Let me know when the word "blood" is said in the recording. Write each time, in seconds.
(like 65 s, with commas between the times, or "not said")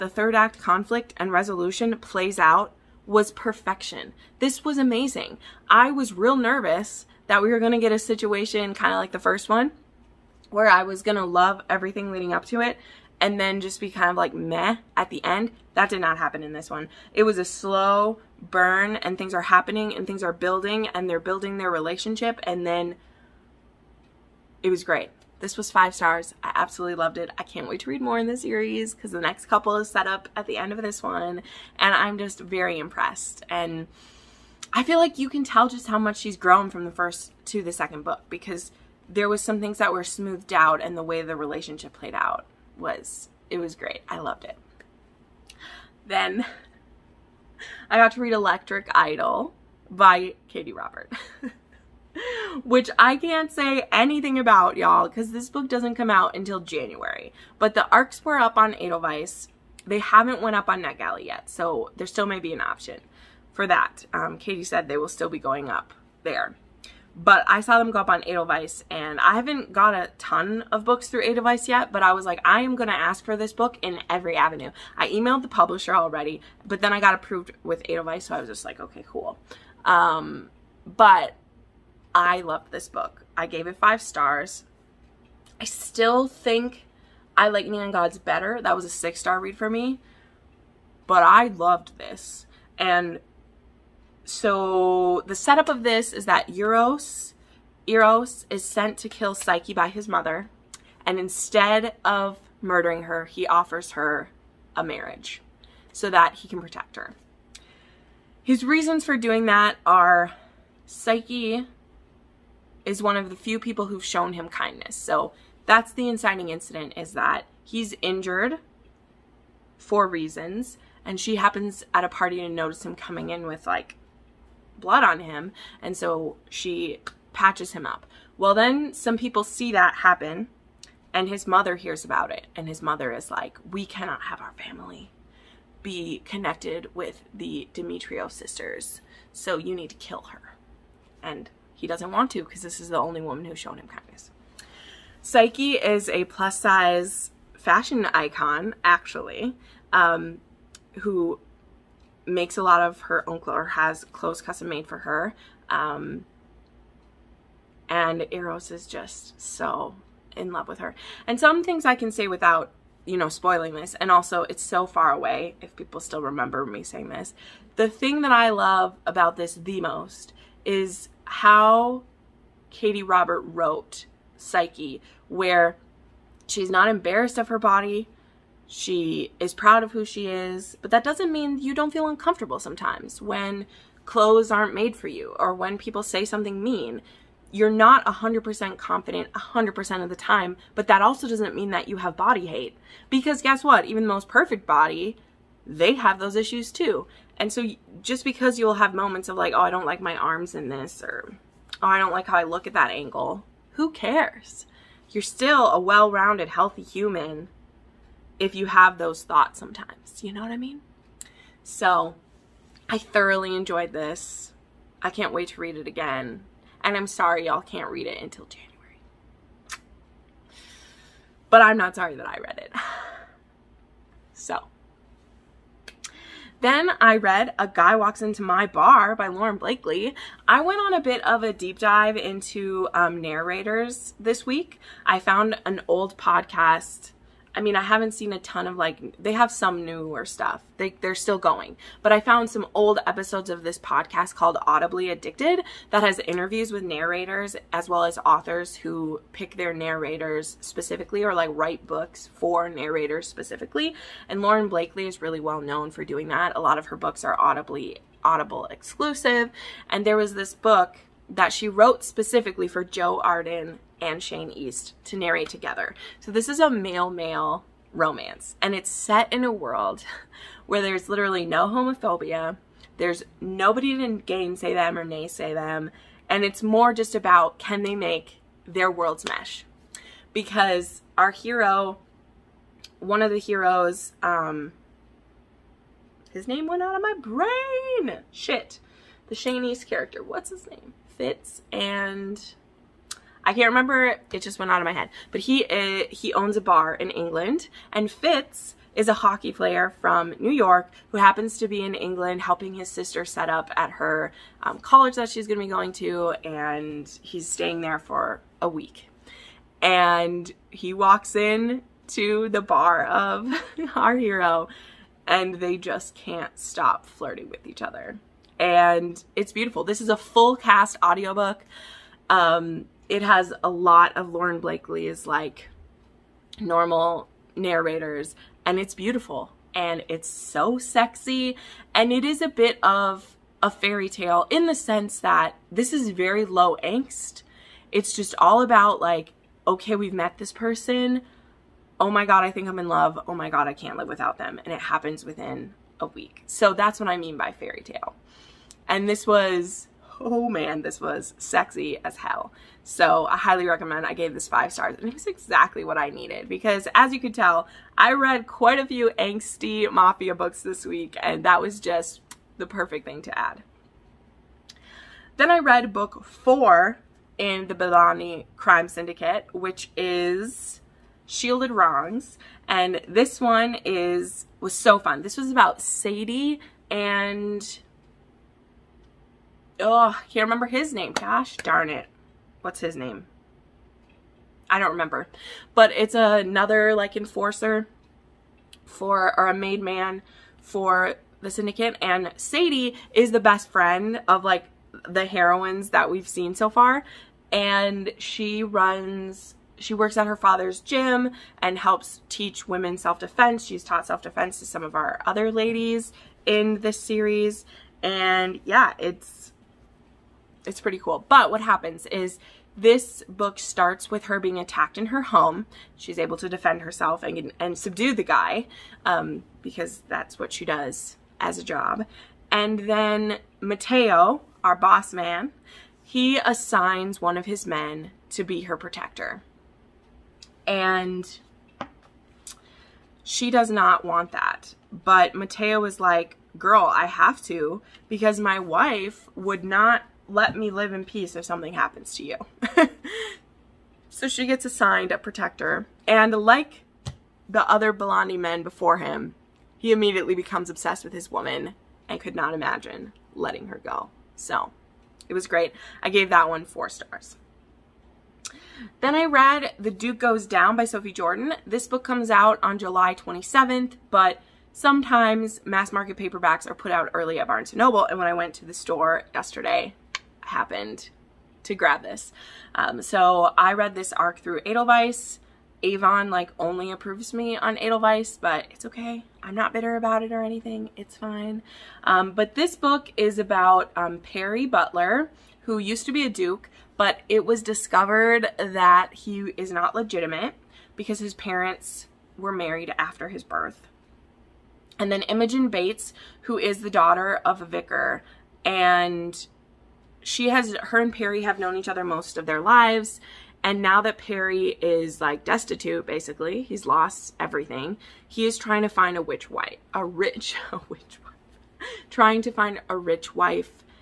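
124 s.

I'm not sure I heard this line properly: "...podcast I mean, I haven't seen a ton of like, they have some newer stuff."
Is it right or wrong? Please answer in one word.
right.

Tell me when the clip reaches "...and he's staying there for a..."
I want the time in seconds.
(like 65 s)
306 s.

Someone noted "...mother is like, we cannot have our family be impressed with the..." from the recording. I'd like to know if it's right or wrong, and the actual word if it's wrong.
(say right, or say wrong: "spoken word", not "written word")
wrong: "connected", not "impressed".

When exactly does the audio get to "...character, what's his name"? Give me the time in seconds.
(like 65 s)
289 s.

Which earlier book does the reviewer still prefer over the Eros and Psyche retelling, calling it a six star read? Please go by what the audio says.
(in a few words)
Neon Gods.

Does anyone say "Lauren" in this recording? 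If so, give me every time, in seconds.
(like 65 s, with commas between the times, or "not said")
229 s, 254 s, 324 s.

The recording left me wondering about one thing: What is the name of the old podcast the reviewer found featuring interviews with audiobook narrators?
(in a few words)
Audibly Addicted.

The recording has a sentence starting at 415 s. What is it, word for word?
She's able to defend herself and, and subdue the guy um, because that's what she does as a job.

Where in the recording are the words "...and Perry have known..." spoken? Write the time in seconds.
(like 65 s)
500 s.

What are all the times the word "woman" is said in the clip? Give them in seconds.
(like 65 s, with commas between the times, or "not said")
143 s, 451 s.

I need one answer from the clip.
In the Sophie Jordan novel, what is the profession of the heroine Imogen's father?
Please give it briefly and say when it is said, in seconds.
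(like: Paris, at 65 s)
Vicar, at 497 s.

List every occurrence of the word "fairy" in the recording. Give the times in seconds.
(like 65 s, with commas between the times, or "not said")
333 s, 347 s.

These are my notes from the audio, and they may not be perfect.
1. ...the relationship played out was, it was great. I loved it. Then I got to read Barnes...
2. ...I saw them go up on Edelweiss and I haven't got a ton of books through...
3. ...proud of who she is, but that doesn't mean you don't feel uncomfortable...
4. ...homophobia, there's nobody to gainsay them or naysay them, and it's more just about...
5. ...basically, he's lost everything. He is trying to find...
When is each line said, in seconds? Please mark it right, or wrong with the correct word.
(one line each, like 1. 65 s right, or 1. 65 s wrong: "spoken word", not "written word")
1. 41 s wrong: "Electric", not "Barnes"
2. 67 s right
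3. 179 s right
4. 271 s right
5. 506 s right.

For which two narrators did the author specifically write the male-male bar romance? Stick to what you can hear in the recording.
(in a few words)
Joe Arden and Shane East.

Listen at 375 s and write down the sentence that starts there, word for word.
This was about Sadie and Oh, can't remember his name.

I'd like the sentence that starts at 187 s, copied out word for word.
You're not 100% confident 100% of the time, but that also doesn't mean that you have body hate.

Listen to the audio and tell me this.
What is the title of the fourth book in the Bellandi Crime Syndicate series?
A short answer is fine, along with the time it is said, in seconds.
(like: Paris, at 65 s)
Shielded Wrongs, at 371 s.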